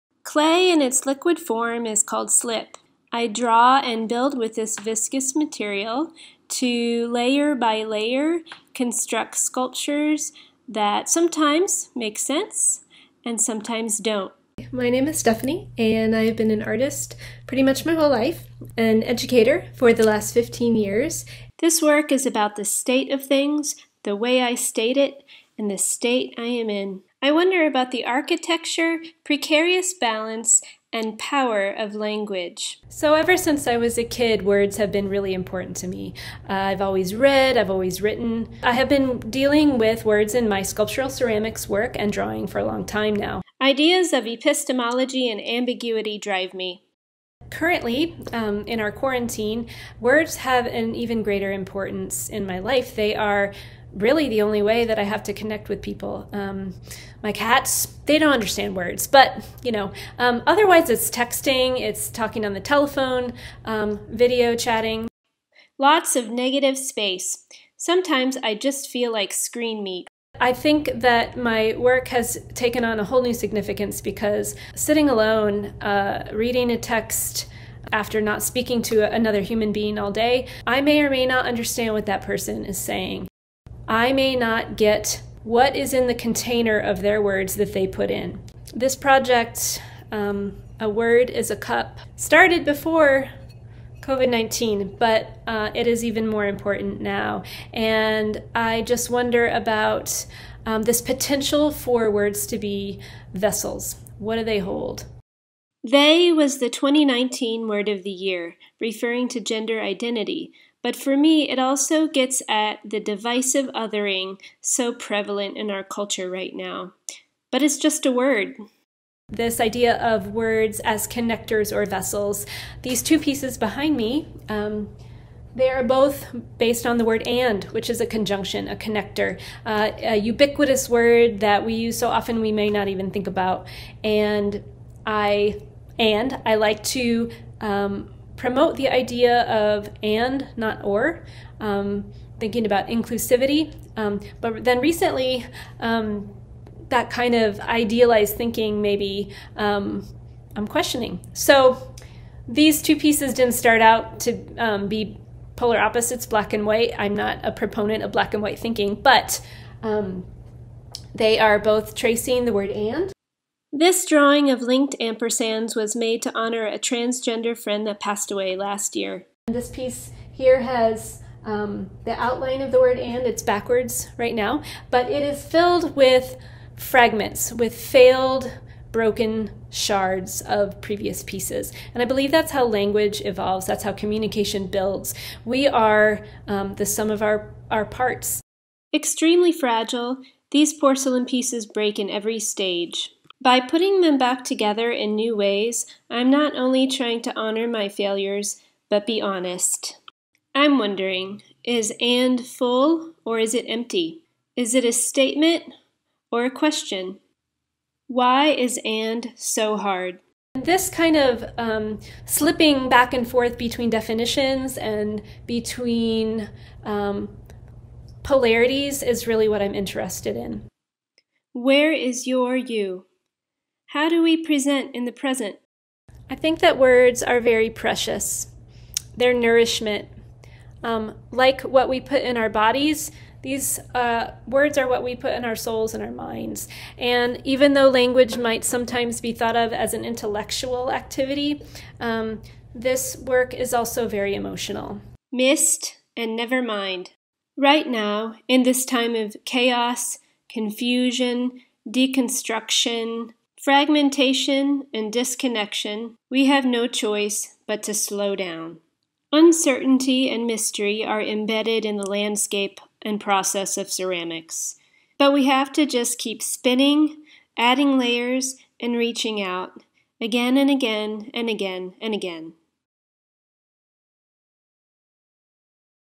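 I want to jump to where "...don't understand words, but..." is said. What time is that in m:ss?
0:58.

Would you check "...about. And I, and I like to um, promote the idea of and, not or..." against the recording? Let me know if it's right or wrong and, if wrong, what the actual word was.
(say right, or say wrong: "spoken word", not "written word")
right.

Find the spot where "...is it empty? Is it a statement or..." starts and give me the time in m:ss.
3:23.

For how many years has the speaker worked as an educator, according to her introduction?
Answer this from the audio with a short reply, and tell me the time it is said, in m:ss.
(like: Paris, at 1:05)
15, at 0:20.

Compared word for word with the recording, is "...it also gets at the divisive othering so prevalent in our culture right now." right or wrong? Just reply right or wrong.
right.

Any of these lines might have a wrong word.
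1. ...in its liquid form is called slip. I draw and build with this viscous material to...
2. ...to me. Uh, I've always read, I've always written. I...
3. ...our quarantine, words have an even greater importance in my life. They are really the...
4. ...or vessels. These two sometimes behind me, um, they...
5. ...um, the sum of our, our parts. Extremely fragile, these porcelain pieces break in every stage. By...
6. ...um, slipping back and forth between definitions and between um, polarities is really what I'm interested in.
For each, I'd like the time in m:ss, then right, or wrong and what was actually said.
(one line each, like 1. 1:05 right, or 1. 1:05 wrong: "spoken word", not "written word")
1. 0:00 right
2. 0:35 right
3. 0:48 right
4. 2:01 wrong: "pieces", not "sometimes"
5. 3:06 right
6. 3:31 right.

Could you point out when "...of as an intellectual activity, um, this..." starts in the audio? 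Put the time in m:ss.
3:59.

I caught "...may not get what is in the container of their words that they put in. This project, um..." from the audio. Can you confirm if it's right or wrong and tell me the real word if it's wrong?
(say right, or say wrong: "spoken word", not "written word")
right.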